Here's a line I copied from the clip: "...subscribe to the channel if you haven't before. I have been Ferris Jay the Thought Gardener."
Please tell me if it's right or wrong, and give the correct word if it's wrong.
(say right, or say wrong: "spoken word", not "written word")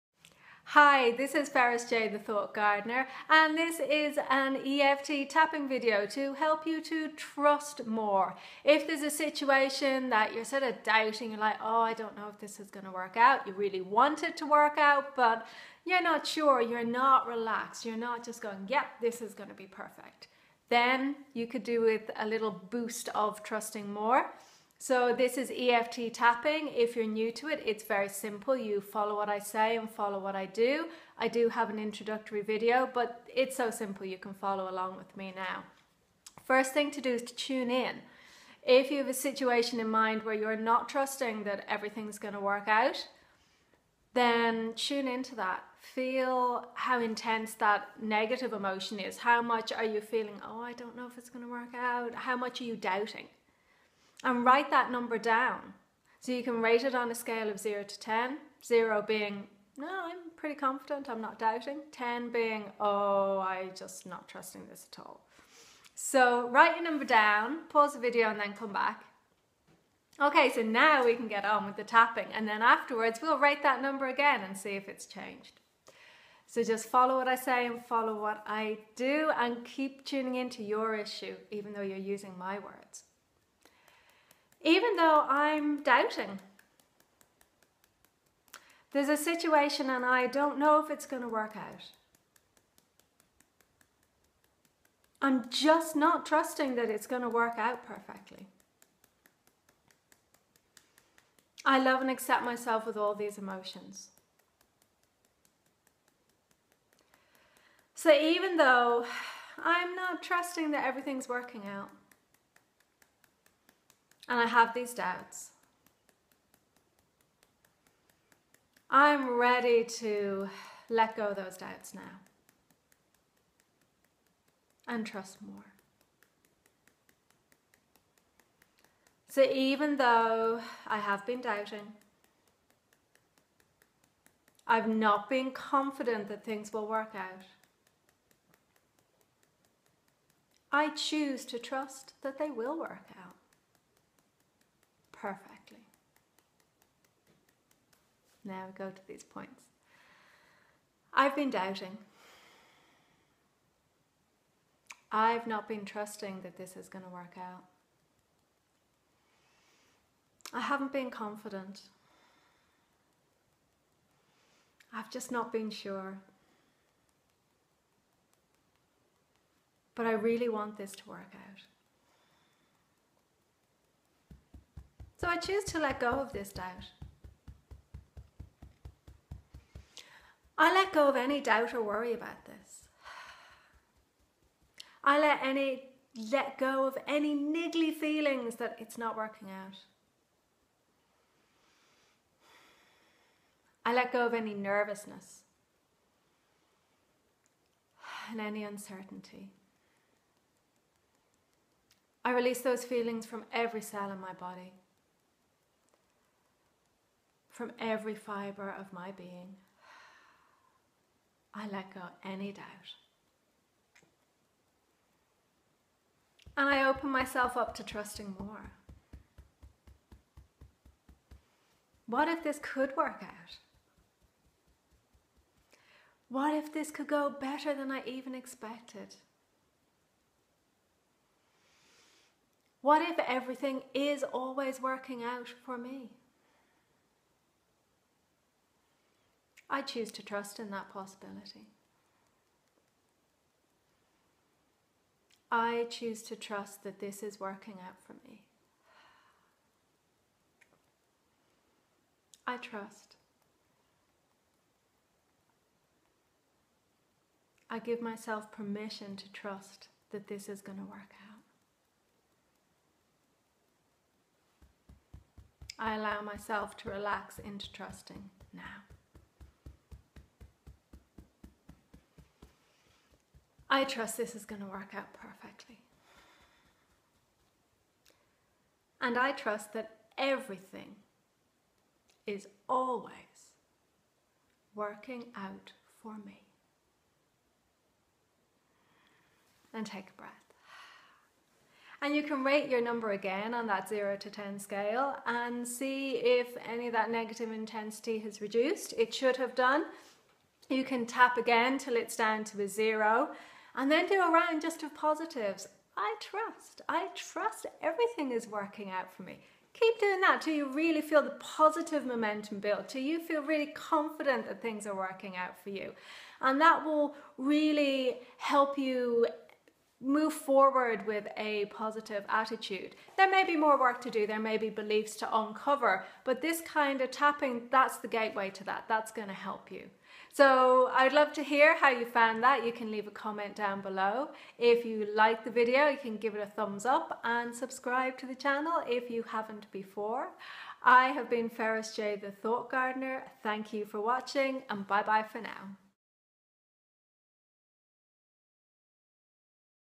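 right.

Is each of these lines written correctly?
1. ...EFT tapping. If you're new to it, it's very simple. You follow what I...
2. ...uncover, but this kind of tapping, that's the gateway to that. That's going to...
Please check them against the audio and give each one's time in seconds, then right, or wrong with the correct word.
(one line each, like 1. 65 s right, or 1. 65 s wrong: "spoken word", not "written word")
1. 25 s right
2. 325 s right.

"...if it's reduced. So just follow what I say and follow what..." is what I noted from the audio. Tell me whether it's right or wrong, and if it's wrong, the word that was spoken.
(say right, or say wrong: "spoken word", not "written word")
wrong: "changed", not "reduced".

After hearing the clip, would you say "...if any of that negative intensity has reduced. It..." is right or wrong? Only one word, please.
right.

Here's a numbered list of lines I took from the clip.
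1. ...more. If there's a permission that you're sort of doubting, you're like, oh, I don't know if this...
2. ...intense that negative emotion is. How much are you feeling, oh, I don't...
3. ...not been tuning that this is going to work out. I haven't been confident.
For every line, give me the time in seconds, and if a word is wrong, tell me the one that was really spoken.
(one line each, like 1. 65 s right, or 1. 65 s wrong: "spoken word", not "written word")
1. 7 s wrong: "situation", not "permission"
2. 46 s right
3. 155 s wrong: "trusting", not "tuning".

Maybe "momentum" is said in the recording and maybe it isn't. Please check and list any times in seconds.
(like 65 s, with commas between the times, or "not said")
312 s.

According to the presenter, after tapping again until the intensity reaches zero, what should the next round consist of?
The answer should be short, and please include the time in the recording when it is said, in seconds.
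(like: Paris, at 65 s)
just of positives, at 304 s.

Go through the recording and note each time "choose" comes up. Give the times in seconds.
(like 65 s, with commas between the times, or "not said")
140 s, 175 s, 239 s, 245 s.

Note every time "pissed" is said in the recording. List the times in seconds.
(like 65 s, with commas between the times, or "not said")
not said.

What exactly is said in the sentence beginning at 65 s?
So write your number down, pause the video and then come back.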